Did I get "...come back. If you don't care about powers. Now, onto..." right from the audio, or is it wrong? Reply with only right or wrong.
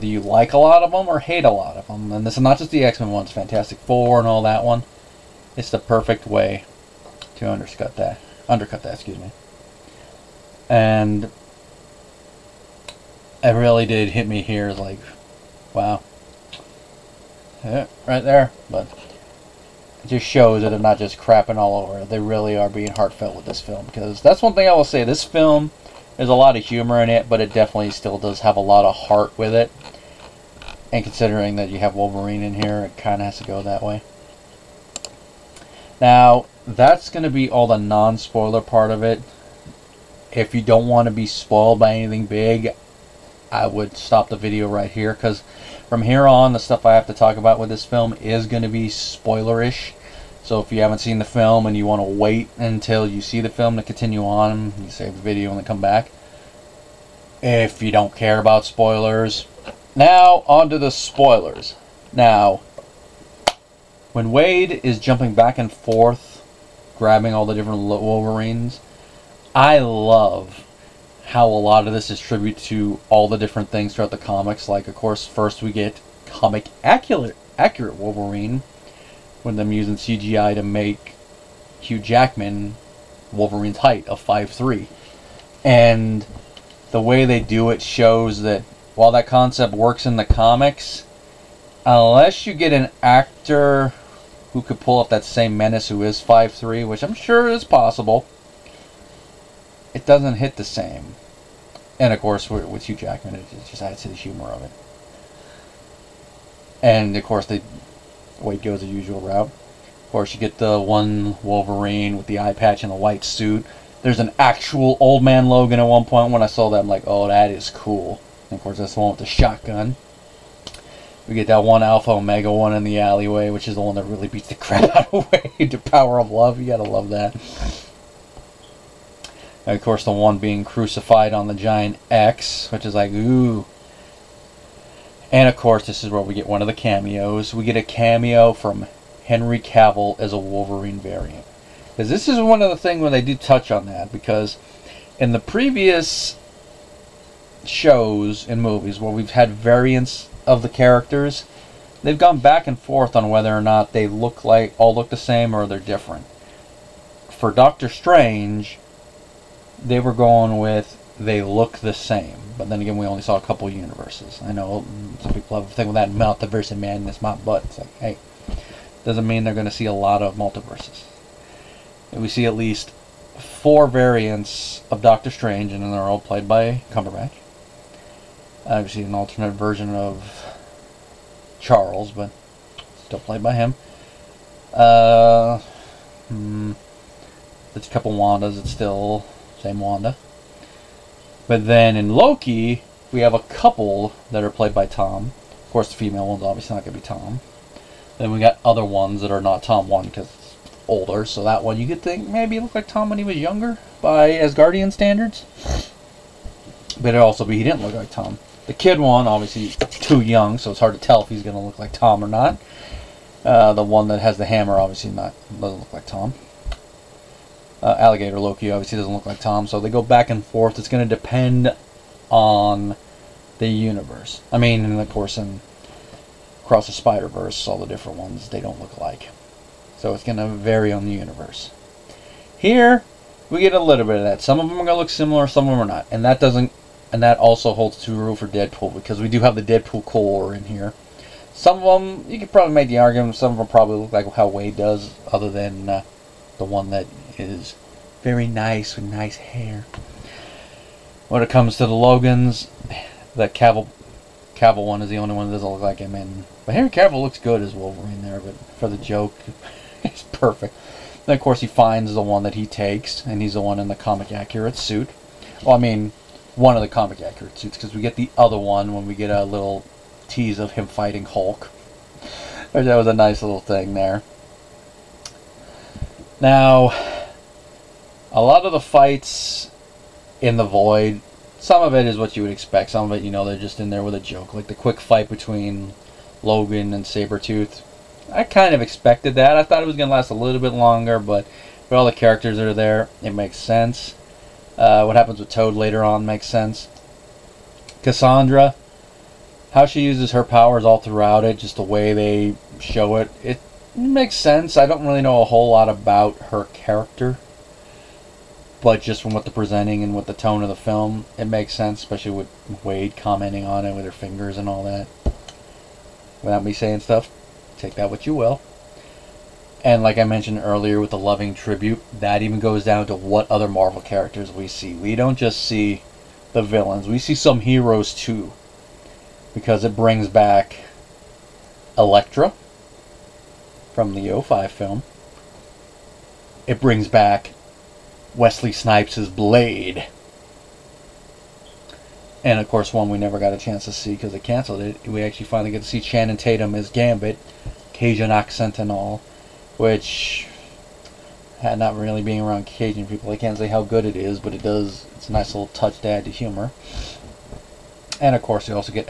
wrong.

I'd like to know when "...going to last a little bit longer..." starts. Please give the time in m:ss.
4:49.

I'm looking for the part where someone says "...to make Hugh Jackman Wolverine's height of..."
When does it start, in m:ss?
1:20.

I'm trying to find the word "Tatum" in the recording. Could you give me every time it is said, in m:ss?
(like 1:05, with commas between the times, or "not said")
5:46.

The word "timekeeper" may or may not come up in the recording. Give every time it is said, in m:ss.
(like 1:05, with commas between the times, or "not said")
not said.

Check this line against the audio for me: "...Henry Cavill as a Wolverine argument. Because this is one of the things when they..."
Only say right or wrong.
wrong.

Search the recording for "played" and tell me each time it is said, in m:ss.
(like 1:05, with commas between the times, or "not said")
2:56, 3:03, 3:14.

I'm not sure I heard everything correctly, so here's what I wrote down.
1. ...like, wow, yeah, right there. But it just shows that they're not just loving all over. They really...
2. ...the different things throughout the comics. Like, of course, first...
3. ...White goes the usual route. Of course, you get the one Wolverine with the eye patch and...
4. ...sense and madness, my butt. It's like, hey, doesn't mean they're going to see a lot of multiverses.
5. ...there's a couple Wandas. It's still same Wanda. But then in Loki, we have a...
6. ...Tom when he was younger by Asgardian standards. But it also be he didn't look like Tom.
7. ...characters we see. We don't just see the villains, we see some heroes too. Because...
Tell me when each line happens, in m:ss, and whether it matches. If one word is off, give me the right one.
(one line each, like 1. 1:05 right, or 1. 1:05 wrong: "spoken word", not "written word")
1. 0:14 wrong: "crapping", not "loving"
2. 1:13 right
3. 1:48 right
4. 2:46 wrong: "multiverse", not "sense"
5. 3:07 right
6. 3:22 right
7. 5:24 right.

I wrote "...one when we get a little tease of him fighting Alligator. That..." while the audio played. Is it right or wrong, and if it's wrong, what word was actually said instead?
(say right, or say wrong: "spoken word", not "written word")
wrong: "Hulk", not "Alligator".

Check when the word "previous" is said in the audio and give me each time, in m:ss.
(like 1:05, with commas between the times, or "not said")
2:25.